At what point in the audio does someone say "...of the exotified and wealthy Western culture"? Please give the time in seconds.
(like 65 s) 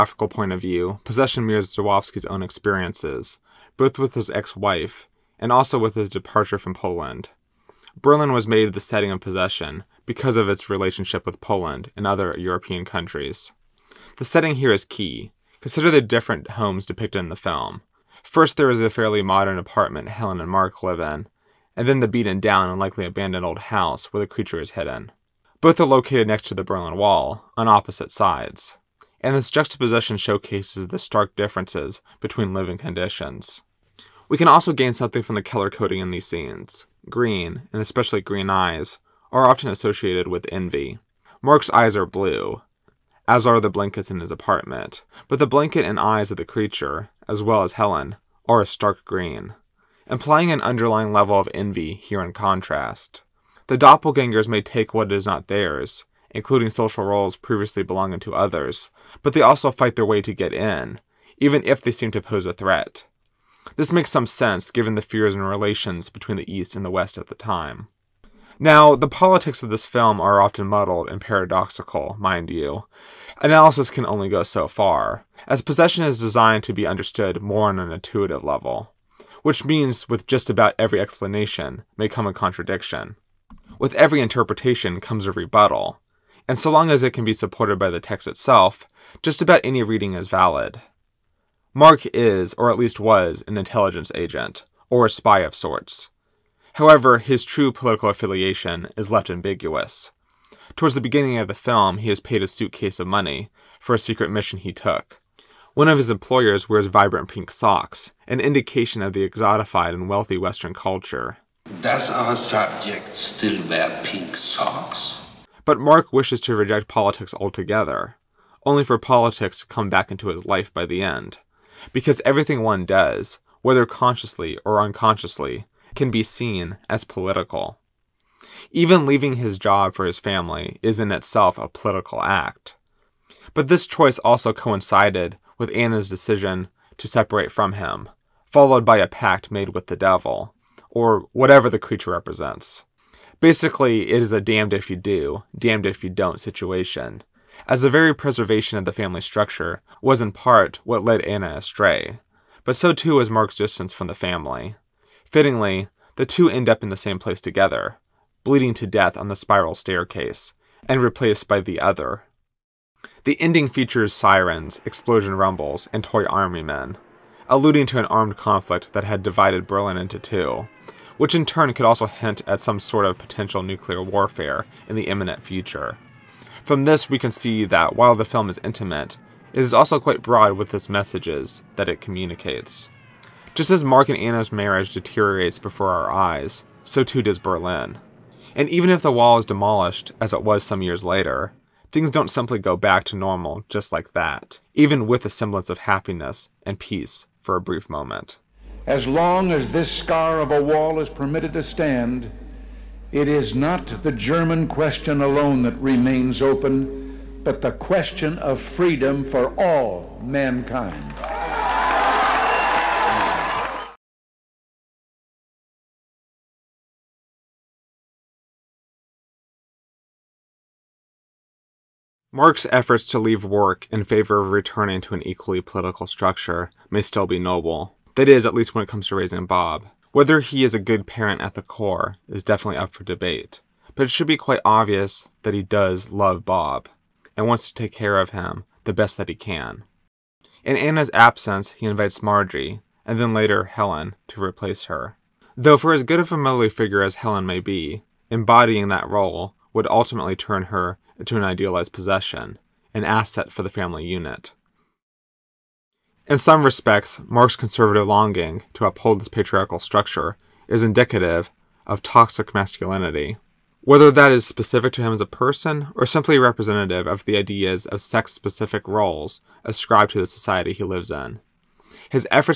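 109 s.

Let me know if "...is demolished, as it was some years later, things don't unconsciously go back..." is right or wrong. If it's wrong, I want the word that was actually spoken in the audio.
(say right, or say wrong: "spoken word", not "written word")
wrong: "simply", not "unconsciously".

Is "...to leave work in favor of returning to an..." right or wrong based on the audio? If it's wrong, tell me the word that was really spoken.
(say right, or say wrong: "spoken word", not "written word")
right.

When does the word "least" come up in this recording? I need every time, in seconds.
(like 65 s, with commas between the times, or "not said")
92 s, 228 s.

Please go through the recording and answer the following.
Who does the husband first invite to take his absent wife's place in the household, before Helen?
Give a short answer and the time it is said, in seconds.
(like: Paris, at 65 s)
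Margie, at 242 s.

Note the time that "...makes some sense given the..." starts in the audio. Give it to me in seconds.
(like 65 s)
63 s.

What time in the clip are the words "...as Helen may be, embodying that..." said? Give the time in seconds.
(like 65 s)
247 s.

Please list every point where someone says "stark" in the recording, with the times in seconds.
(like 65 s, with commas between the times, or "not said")
30 s, 48 s.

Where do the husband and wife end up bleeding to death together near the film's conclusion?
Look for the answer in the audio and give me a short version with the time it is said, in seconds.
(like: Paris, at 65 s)
The spiral staircase, at 159 s.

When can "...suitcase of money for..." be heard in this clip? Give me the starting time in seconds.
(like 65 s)
102 s.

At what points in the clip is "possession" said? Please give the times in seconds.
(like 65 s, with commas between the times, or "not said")
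1 s, 9 s, 75 s, 251 s.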